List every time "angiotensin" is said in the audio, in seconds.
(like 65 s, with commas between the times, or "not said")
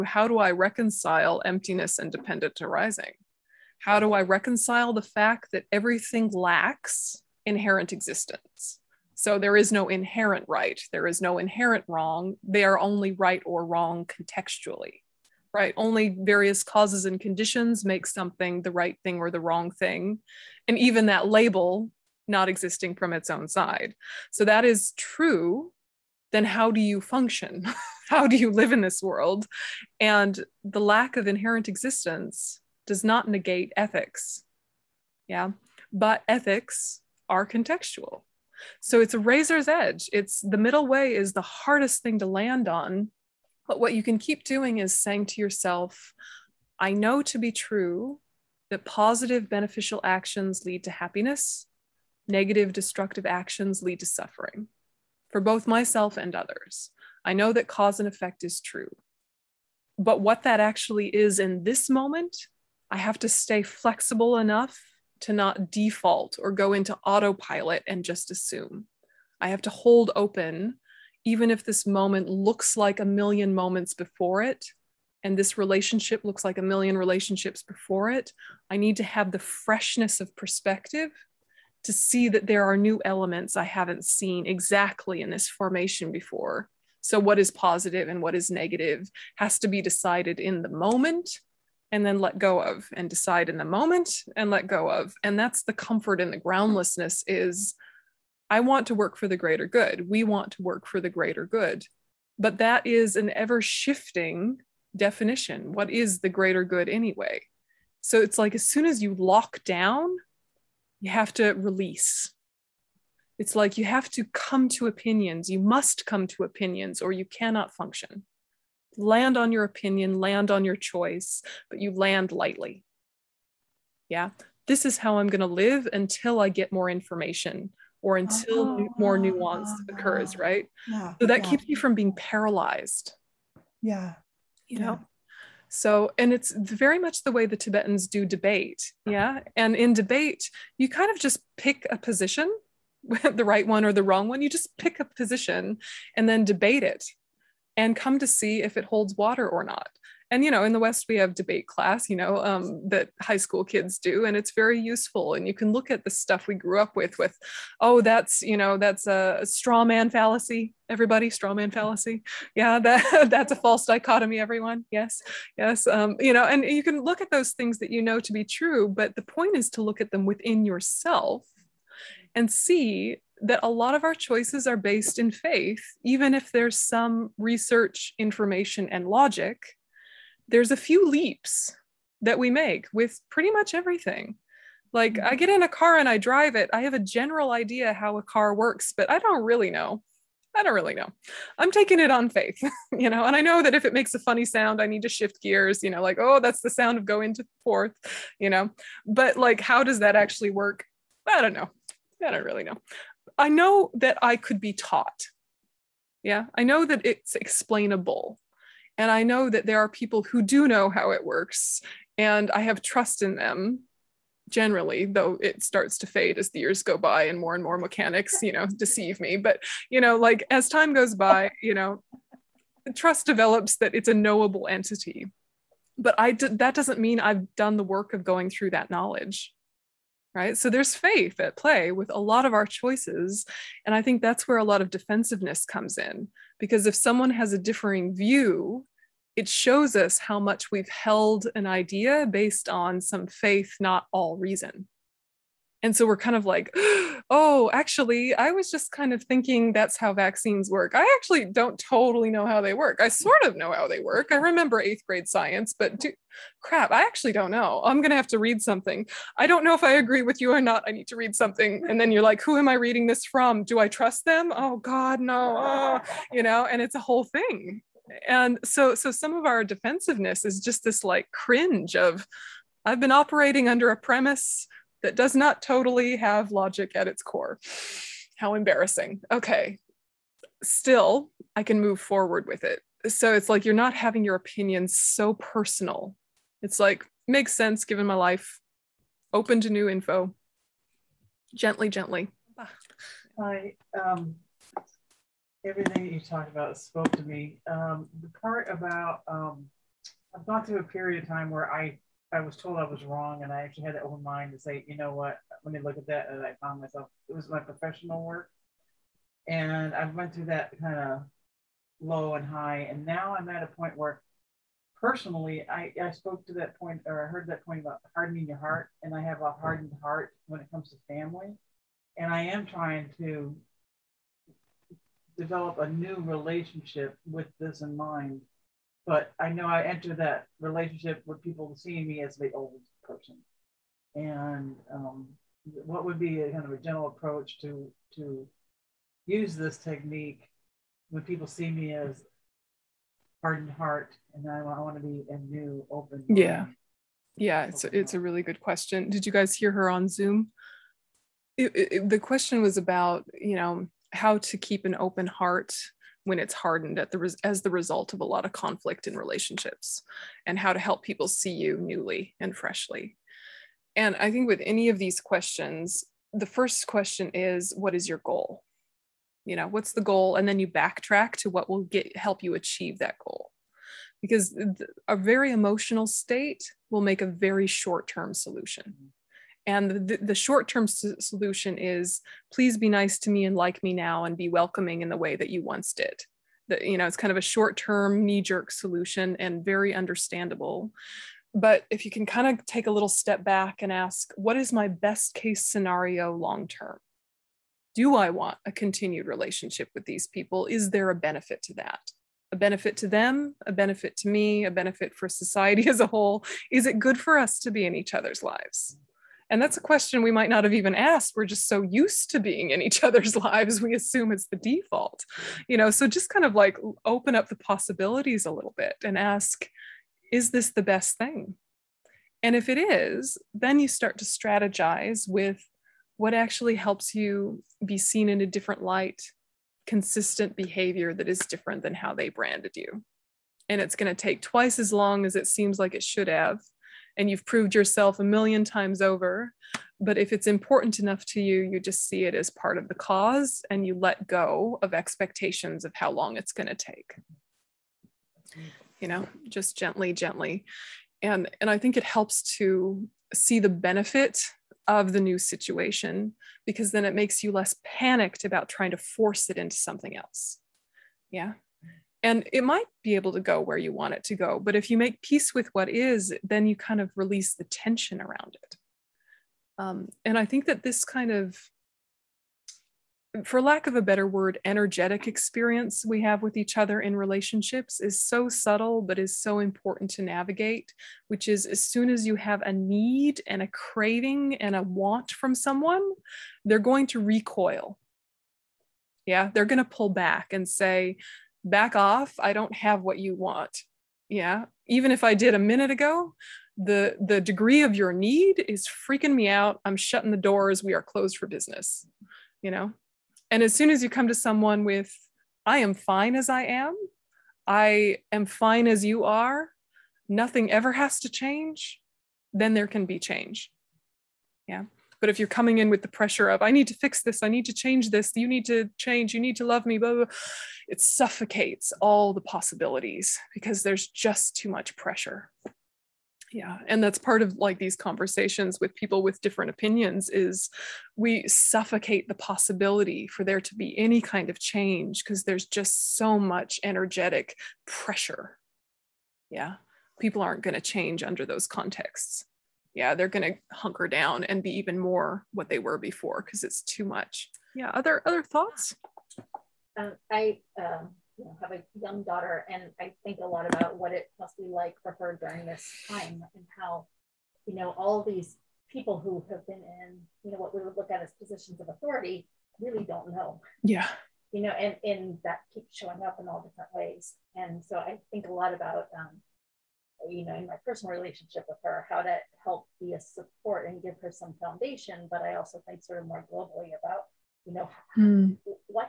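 not said.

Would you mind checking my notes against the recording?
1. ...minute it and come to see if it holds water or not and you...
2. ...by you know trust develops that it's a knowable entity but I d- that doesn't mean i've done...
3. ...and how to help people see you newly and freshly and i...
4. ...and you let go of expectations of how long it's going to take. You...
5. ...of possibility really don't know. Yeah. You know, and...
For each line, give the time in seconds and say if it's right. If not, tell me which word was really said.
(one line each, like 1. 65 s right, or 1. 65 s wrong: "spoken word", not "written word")
1. 146 s wrong: "debate", not "minute"
2. 221 s right
3. 360 s right
4. 443 s right
5. 561 s wrong: "authority", not "possibility".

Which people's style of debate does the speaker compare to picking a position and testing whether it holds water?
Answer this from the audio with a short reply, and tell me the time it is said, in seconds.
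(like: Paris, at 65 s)
The Tibetans, at 137 s.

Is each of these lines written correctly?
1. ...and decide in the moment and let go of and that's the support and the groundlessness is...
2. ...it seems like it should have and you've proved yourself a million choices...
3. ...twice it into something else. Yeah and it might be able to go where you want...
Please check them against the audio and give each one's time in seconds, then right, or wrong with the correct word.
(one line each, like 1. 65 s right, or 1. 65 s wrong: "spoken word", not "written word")
1. 92 s wrong: "comfort", not "support"
2. 435 s wrong: "times", not "choices"
3. 458 s wrong: "force", not "twice".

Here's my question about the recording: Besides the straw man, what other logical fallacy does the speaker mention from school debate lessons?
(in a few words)
False dichotomy.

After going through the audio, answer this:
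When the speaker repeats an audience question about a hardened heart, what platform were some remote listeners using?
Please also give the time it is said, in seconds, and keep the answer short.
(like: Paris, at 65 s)
Zoom, at 350 s.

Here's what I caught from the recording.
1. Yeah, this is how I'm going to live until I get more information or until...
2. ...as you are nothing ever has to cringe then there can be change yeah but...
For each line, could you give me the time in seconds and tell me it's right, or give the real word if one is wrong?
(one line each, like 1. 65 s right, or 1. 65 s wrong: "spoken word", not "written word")
1. 124 s right
2. 508 s wrong: "change", not "cringe".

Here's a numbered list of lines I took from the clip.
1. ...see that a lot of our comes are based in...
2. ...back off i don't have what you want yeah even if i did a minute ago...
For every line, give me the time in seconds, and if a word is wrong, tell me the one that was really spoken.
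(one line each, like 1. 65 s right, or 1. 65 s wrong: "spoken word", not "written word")
1. 172 s wrong: "choices", not "comes"
2. 491 s right.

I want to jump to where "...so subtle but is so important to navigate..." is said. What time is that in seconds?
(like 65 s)
478 s.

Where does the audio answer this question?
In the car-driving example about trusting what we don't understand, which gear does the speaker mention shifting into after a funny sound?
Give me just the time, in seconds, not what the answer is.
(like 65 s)
197 s.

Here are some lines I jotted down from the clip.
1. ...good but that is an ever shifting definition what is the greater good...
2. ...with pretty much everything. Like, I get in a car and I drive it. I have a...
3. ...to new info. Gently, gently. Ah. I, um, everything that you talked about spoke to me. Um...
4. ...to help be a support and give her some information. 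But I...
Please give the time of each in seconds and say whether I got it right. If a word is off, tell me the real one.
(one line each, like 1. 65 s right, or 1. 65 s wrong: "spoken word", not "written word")
1. 101 s right
2. 182 s right
3. 289 s right
4. 572 s wrong: "foundation", not "information".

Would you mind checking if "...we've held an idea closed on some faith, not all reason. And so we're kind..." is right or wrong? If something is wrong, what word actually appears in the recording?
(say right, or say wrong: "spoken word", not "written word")
wrong: "based", not "closed".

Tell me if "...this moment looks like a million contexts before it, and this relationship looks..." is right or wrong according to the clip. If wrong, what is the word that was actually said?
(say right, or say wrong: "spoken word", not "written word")
wrong: "moments", not "contexts".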